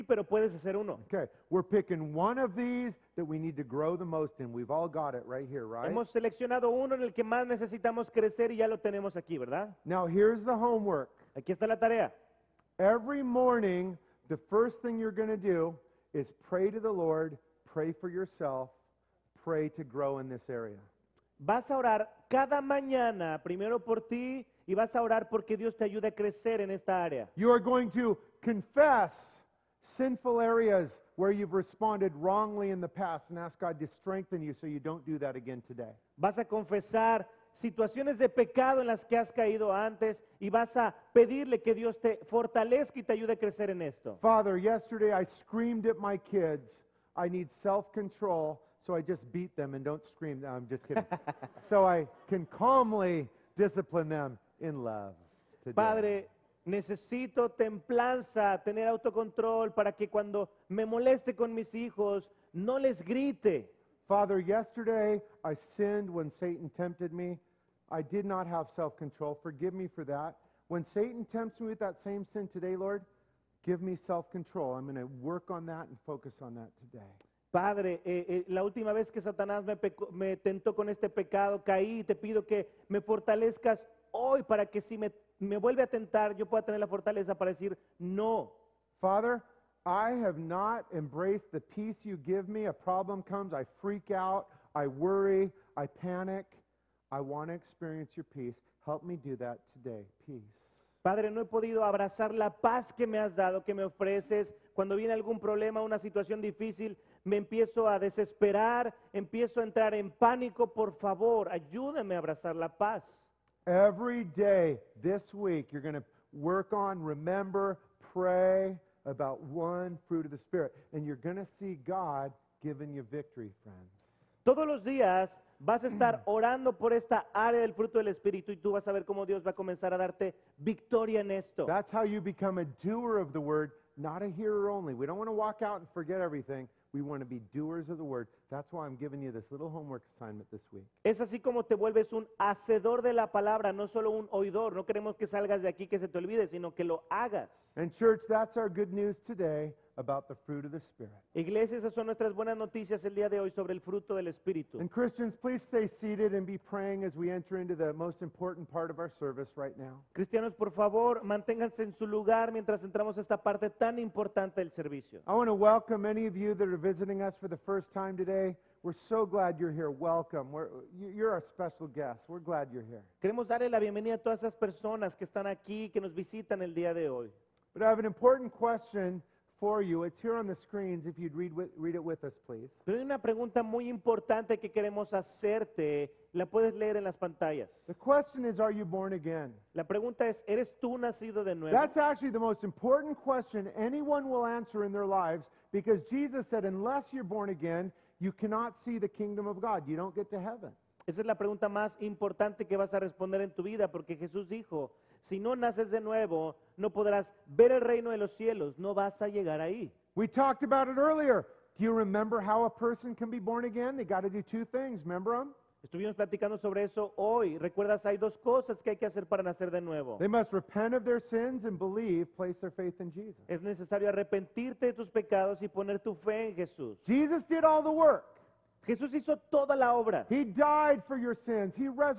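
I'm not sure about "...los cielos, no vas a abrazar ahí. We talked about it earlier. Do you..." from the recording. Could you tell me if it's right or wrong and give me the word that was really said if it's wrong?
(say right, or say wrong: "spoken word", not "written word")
wrong: "llegar", not "abrazar".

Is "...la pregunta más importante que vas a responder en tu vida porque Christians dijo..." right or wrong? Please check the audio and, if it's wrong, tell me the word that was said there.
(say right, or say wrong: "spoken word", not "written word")
wrong: "Jesús", not "Christians".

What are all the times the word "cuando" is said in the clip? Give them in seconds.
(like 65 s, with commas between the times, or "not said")
60 s, 104 s.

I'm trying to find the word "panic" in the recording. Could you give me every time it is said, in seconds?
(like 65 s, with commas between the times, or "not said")
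95 s.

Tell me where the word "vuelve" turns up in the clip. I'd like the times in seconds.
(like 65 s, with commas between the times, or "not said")
85 s, 141 s.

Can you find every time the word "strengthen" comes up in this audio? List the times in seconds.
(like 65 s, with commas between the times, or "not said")
34 s.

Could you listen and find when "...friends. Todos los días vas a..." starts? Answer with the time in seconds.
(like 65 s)
123 s.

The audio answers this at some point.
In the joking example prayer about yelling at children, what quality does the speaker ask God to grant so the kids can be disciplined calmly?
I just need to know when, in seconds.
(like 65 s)
47 s.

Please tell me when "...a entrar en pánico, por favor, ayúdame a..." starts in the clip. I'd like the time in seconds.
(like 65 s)
109 s.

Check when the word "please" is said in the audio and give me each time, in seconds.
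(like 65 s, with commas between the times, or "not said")
155 s, 182 s.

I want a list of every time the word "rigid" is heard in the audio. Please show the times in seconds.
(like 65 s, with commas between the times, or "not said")
not said.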